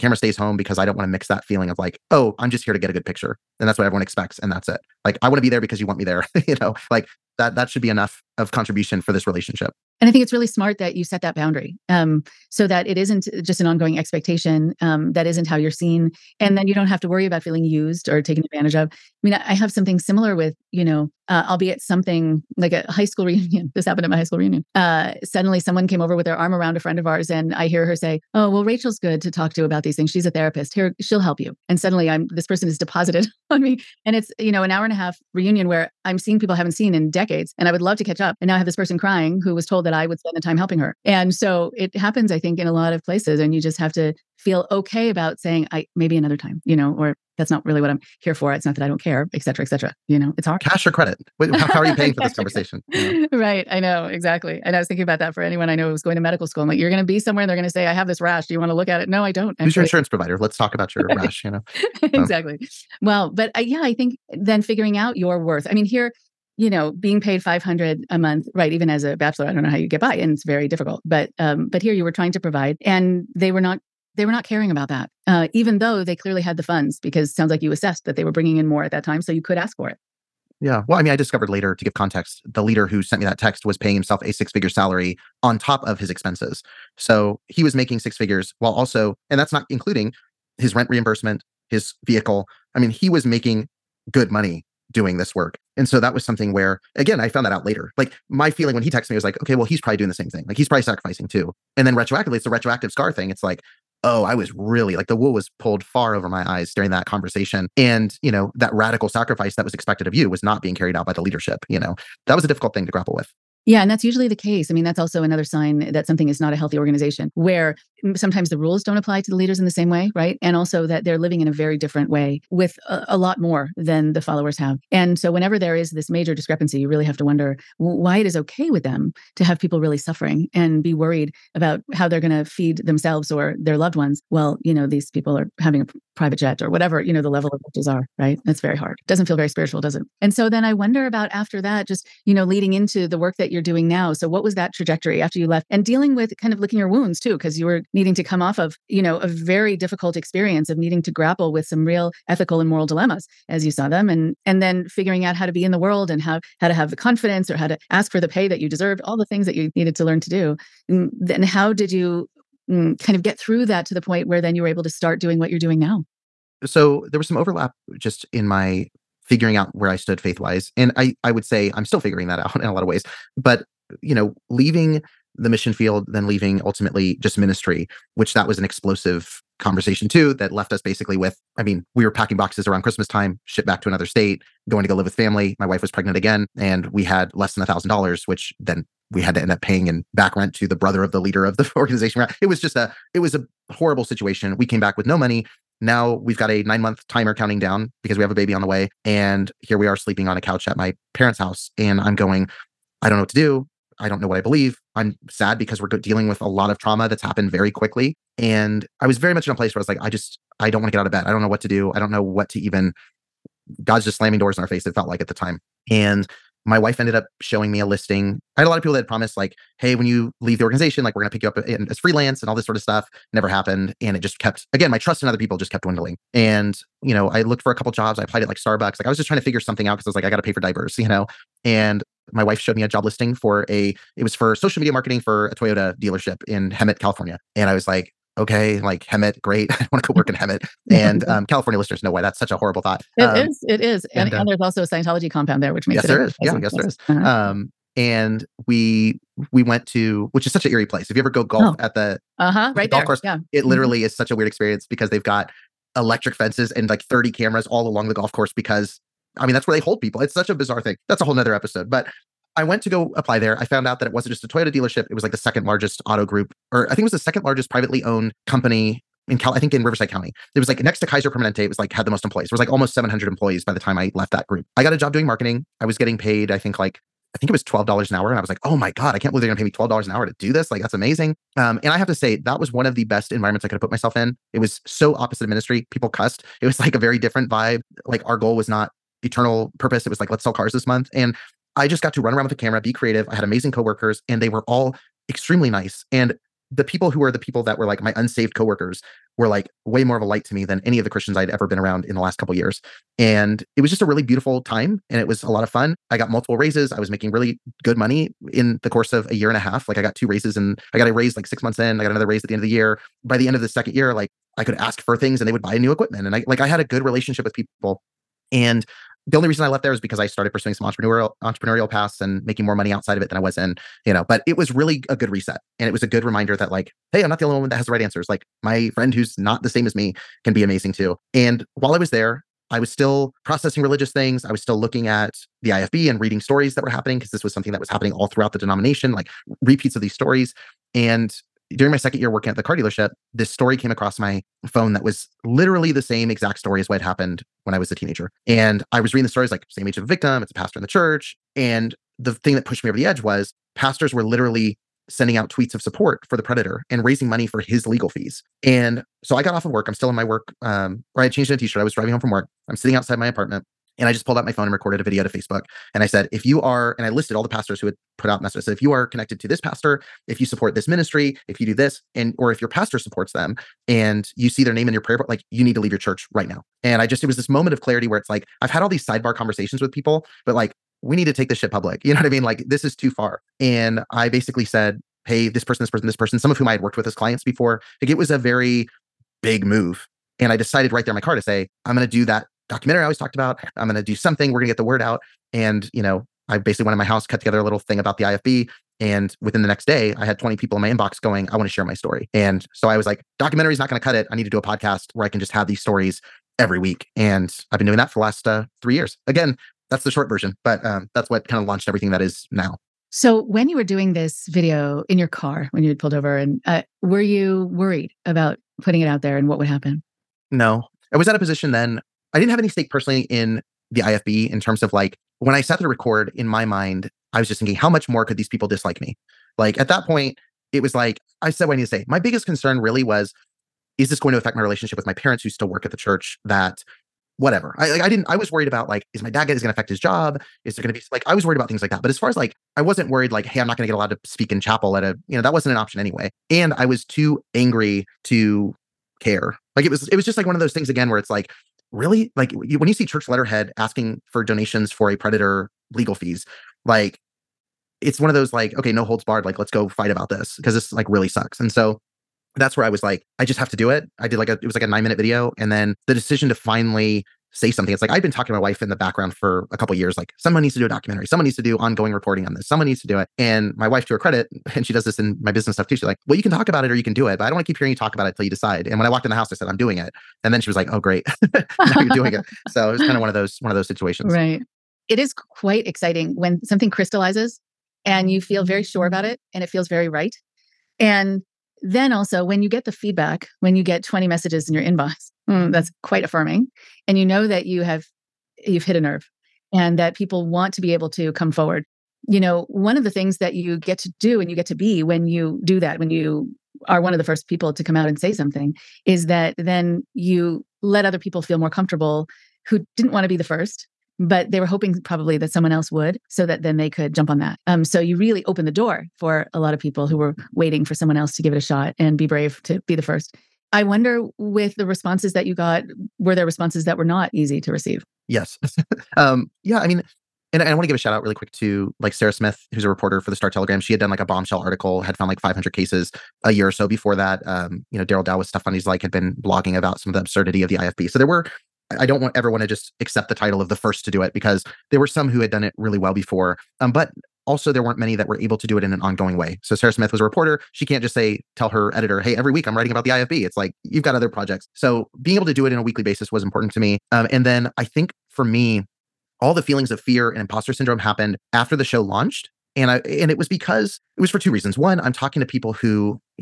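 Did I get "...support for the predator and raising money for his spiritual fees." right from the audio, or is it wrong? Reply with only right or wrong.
wrong.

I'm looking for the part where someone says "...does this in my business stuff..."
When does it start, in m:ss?
7:54.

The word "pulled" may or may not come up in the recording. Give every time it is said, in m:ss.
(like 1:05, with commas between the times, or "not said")
1:45, 6:04, 6:55.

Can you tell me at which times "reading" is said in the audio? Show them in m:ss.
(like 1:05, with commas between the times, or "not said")
5:36, 5:49.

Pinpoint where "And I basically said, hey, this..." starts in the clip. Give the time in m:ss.
6:23.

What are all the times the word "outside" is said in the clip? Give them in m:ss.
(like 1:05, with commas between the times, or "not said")
5:22, 6:02.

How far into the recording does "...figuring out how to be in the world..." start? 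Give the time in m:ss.
2:34.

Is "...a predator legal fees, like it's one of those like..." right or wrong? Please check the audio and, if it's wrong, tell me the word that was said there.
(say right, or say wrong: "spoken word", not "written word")
right.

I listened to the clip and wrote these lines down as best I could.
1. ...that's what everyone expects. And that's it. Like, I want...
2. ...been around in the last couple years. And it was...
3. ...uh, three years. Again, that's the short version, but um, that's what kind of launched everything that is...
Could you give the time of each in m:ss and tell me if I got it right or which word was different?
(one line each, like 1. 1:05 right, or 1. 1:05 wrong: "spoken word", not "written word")
1. 0:03 right
2. 5:01 right
3. 6:48 right.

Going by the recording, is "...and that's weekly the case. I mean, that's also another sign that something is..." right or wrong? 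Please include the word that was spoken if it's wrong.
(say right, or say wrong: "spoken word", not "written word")
wrong: "usually", not "weekly".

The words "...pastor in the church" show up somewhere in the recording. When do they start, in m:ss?
5:50.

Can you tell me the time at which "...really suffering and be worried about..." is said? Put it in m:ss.
2:09.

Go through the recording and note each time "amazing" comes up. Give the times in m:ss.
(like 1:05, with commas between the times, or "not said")
4:40, 4:53, 5:30.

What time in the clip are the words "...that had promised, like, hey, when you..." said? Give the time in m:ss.
3:38.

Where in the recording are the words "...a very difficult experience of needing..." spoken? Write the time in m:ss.
2:29.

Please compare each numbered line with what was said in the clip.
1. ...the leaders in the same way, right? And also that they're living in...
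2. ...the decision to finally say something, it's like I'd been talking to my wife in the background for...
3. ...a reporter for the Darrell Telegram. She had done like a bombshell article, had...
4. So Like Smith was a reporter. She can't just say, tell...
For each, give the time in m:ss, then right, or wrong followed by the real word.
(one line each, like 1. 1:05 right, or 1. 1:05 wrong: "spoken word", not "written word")
1. 1:59 right
2. 7:46 right
3. 8:52 wrong: "Star", not "Darrell"
4. 9:09 wrong: "Sarah", not "Like".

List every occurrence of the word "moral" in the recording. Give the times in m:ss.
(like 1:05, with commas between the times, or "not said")
2:32.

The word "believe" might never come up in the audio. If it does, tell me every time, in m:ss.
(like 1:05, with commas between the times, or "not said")
3:24, 4:39.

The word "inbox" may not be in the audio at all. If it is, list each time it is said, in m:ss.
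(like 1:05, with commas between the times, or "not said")
6:40, 8:14.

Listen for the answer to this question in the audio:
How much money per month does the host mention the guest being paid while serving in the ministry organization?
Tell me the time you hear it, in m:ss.
1:07.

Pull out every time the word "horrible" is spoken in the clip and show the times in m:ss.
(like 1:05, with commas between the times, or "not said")
3:13, 4:02.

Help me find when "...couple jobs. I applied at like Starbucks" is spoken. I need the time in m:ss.
3:47.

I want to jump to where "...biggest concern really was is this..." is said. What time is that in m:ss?
7:12.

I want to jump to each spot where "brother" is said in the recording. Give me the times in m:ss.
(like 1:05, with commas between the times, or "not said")
3:10.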